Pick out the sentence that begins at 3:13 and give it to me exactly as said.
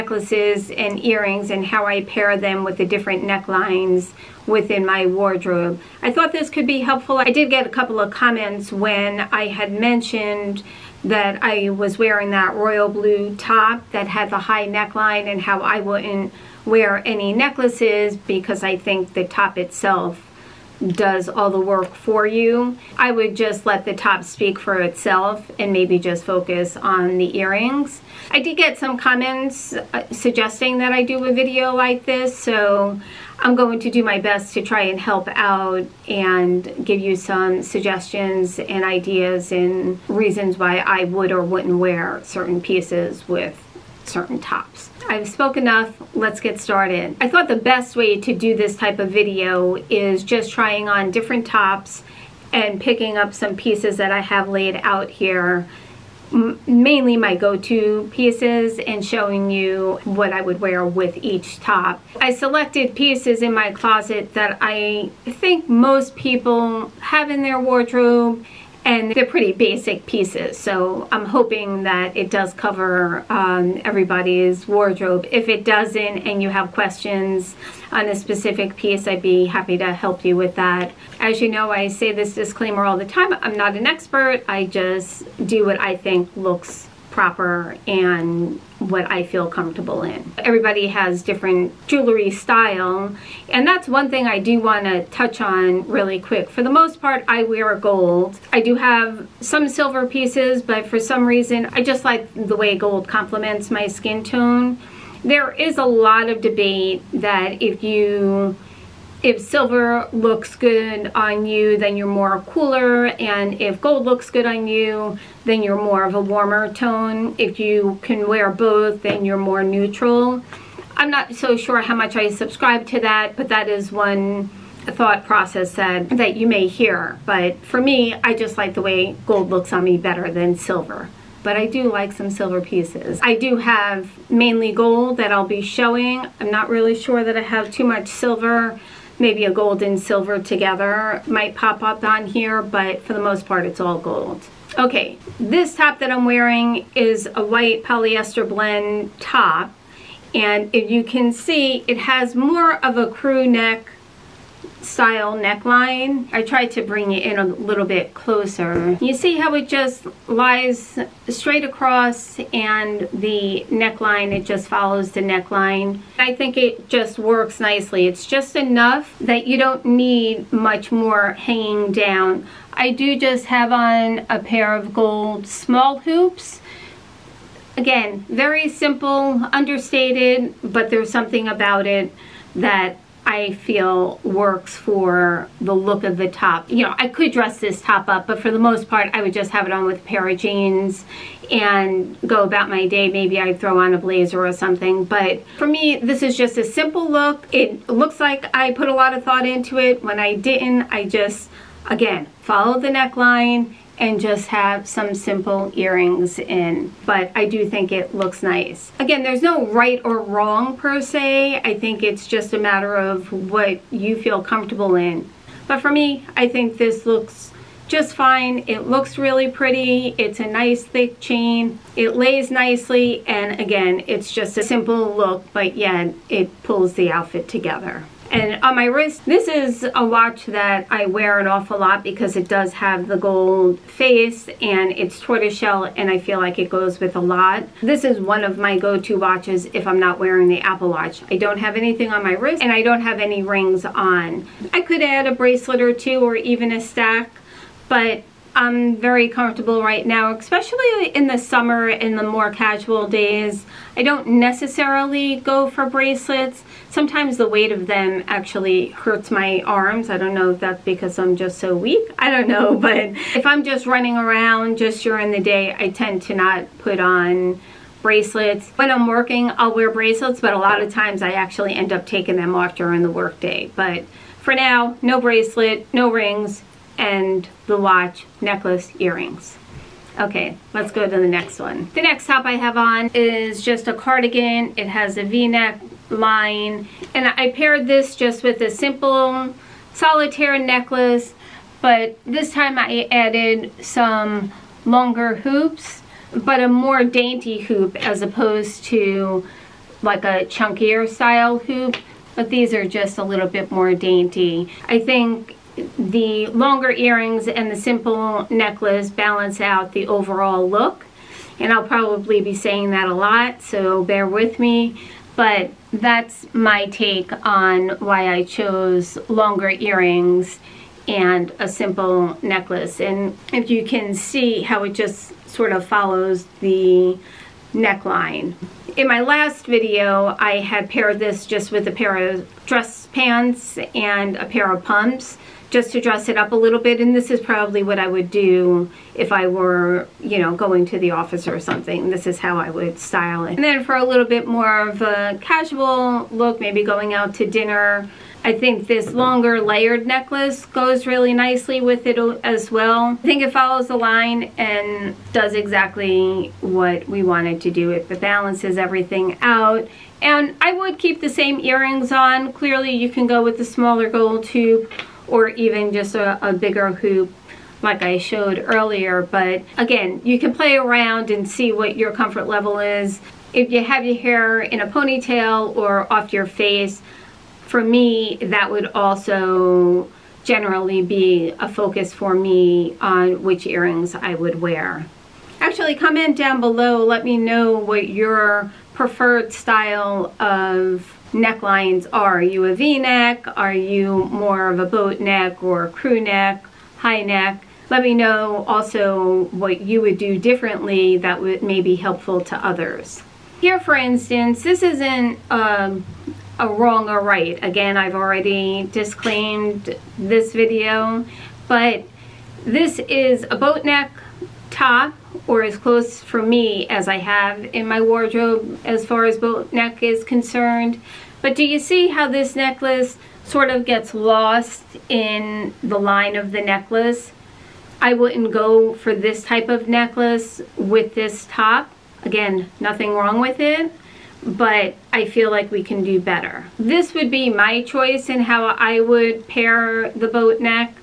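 Maybe I'd throw on a blazer or something.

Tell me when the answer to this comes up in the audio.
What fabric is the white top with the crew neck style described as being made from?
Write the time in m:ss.
2:27.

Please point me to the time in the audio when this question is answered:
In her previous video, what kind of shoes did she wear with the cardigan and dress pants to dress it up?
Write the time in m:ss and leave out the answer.
5:34.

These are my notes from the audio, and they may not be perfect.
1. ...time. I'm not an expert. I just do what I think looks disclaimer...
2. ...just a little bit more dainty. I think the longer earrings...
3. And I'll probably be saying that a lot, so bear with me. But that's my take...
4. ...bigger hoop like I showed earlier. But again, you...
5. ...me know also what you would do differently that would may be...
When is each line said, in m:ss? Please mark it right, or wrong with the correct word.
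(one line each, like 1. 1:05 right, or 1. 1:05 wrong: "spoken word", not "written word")
1. 1:23 wrong: "proper", not "disclaimer"
2. 5:02 right
3. 5:11 right
4. 6:06 right
5. 6:38 right.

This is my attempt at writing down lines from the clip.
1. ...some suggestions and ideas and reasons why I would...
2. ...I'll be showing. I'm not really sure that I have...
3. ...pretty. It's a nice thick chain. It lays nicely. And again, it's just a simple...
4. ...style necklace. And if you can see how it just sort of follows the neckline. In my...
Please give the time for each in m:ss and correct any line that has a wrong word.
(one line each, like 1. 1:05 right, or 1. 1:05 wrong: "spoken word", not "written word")
1. 0:37 right
2. 2:15 right
3. 3:39 right
4. 5:21 wrong: "simple", not "style".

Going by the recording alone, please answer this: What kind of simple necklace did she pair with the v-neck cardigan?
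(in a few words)
solitaire necklace.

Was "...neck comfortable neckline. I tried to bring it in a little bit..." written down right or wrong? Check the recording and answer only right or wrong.
wrong.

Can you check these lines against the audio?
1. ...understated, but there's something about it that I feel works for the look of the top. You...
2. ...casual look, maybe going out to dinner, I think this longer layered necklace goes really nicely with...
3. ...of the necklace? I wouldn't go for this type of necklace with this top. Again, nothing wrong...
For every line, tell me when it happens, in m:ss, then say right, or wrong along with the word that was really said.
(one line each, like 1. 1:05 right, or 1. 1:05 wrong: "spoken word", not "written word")
1. 2:59 right
2. 5:45 right
3. 7:06 right.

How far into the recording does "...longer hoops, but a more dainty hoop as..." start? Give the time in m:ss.
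4:54.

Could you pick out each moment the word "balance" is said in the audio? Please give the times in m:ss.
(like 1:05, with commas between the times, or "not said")
5:09, 5:58.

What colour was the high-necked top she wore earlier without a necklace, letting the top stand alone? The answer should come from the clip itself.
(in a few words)
royal blue.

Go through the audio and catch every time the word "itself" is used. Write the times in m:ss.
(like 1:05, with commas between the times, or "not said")
0:19, 0:24.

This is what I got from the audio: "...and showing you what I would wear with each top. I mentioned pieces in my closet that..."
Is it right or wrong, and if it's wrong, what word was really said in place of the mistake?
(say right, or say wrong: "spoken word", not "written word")
wrong: "selected", not "mentioned".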